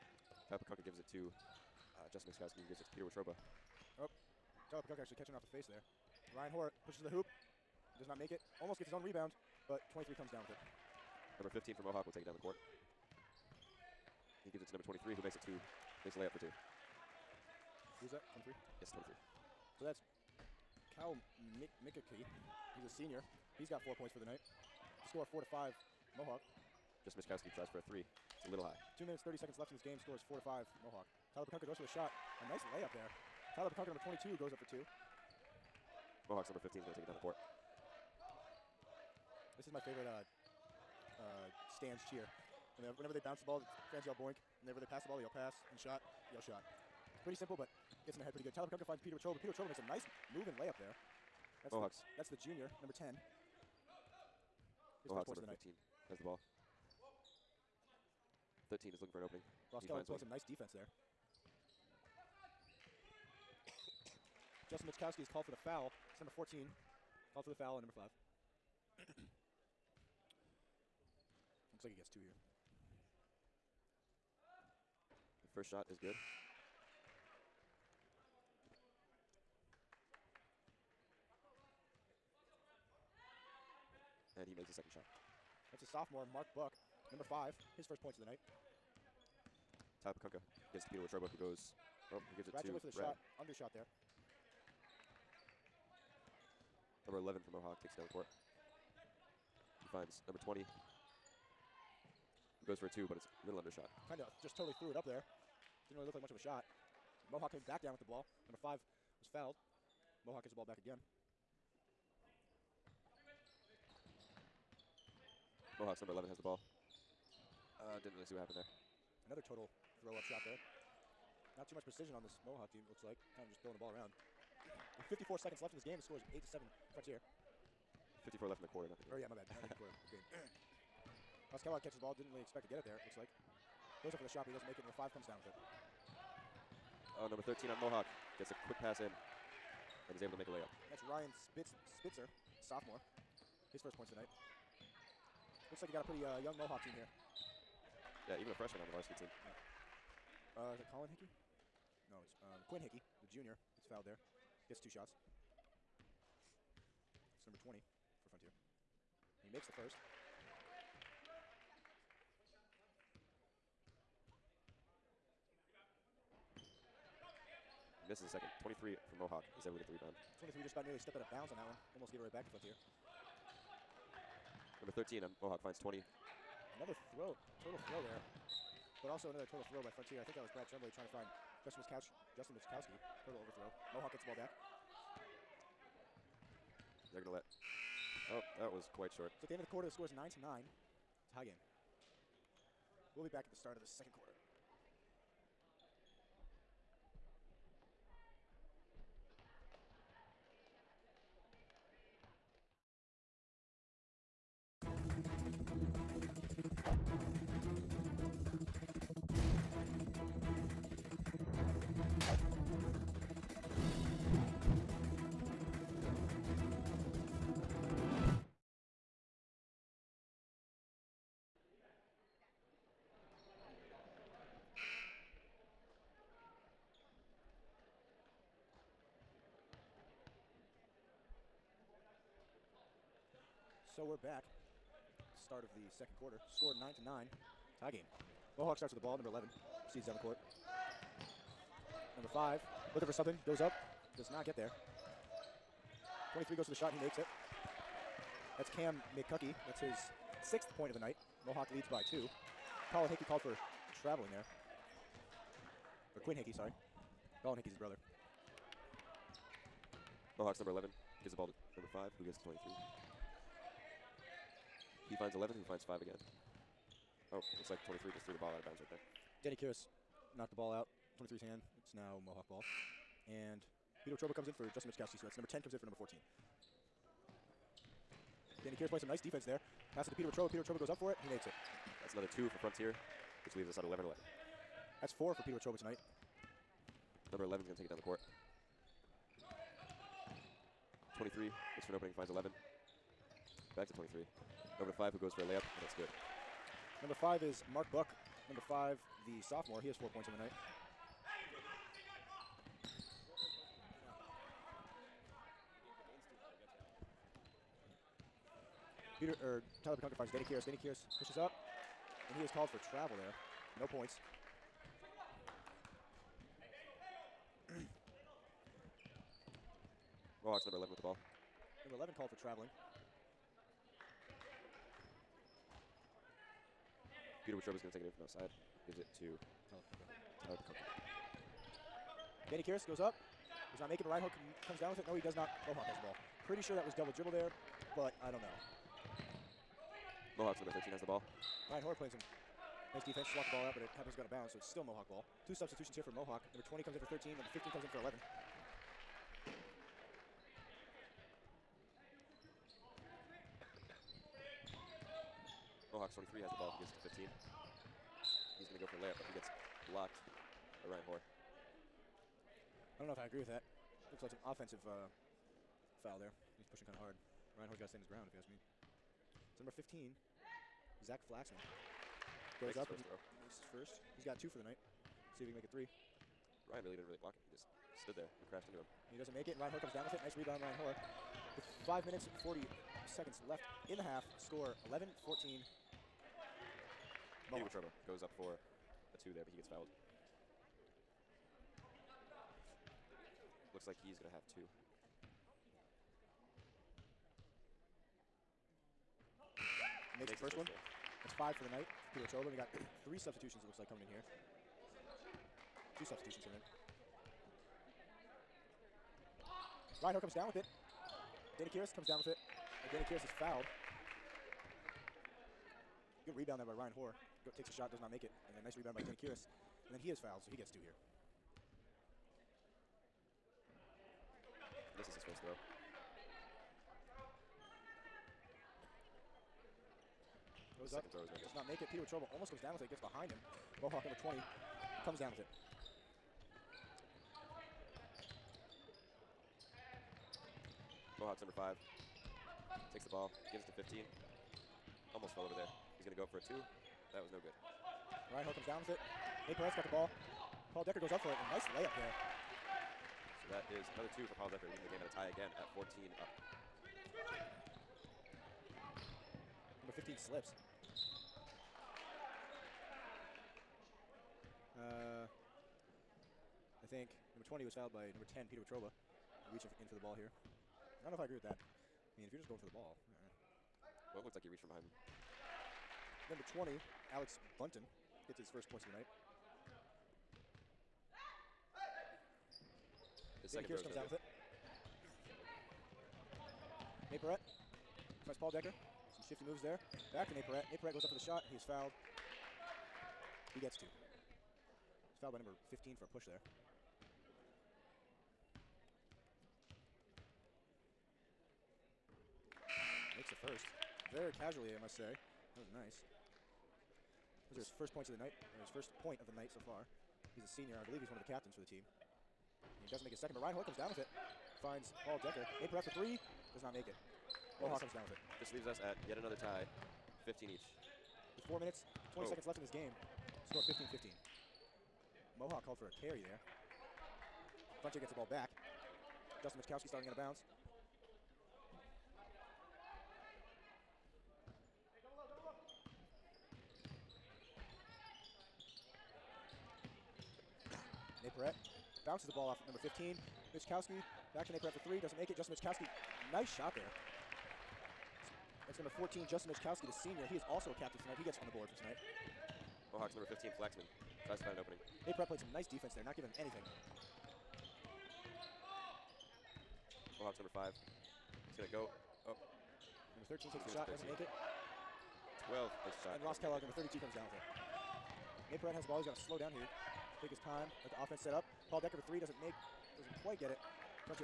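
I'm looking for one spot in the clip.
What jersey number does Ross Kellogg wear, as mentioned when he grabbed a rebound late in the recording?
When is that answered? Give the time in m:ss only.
9:26.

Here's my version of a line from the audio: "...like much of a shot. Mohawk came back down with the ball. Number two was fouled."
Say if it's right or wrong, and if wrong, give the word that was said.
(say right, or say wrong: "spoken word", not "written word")
wrong: "five", not "two".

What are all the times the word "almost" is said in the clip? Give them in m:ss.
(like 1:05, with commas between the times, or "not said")
0:08, 2:51, 7:12, 7:25.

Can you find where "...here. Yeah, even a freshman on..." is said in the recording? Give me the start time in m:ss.
2:26.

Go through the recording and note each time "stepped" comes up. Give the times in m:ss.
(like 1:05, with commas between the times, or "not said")
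2:50.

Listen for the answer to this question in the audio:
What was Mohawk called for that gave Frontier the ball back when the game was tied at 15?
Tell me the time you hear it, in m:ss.
8:45.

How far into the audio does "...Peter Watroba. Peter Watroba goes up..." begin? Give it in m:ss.
4:40.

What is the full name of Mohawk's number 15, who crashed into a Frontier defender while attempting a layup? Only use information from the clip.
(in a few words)
Zach Flaxman.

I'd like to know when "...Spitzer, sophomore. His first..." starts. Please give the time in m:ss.
2:21.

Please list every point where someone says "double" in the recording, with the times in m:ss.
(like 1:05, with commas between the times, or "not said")
5:36.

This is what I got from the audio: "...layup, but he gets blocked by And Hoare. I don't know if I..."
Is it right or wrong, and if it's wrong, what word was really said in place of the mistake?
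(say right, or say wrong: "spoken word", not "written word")
wrong: "Ryan", not "And".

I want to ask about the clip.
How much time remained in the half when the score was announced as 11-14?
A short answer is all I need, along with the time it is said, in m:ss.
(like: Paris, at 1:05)
5 minutes 40 seconds, at 6:21.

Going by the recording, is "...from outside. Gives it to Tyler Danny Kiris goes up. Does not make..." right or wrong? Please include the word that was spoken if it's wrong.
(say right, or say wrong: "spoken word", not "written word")
right.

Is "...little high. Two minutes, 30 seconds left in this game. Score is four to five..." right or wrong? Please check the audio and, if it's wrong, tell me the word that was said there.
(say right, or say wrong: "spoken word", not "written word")
right.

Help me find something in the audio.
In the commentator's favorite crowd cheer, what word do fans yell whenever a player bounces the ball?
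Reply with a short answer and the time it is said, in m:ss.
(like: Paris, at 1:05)
Boink, at 0:44.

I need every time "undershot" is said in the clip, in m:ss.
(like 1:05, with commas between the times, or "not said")
1:33, 1:43.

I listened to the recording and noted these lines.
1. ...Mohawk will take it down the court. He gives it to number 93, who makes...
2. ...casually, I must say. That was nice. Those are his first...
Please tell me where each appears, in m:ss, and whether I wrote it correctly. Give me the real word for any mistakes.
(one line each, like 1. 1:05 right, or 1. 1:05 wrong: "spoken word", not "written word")
1. 0:11 wrong: "23", not "93"
2. 8:24 right.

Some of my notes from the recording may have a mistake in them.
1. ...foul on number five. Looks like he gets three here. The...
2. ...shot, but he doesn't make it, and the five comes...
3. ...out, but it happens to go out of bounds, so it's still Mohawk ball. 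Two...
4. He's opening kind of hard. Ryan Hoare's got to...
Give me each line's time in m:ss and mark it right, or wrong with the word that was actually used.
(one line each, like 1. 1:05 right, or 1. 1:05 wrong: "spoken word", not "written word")
1. 1:07 wrong: "two", not "three"
2. 2:14 right
3. 5:43 right
4. 6:06 wrong: "pushing", not "opening".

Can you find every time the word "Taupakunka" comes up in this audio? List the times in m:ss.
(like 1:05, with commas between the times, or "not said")
0:00, 0:04.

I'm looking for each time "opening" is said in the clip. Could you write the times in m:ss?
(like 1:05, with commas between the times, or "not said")
0:59, 4:51, 9:14.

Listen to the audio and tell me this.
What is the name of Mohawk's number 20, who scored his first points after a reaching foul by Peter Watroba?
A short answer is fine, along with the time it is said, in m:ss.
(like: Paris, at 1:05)
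Alex Bunton, at 7:57.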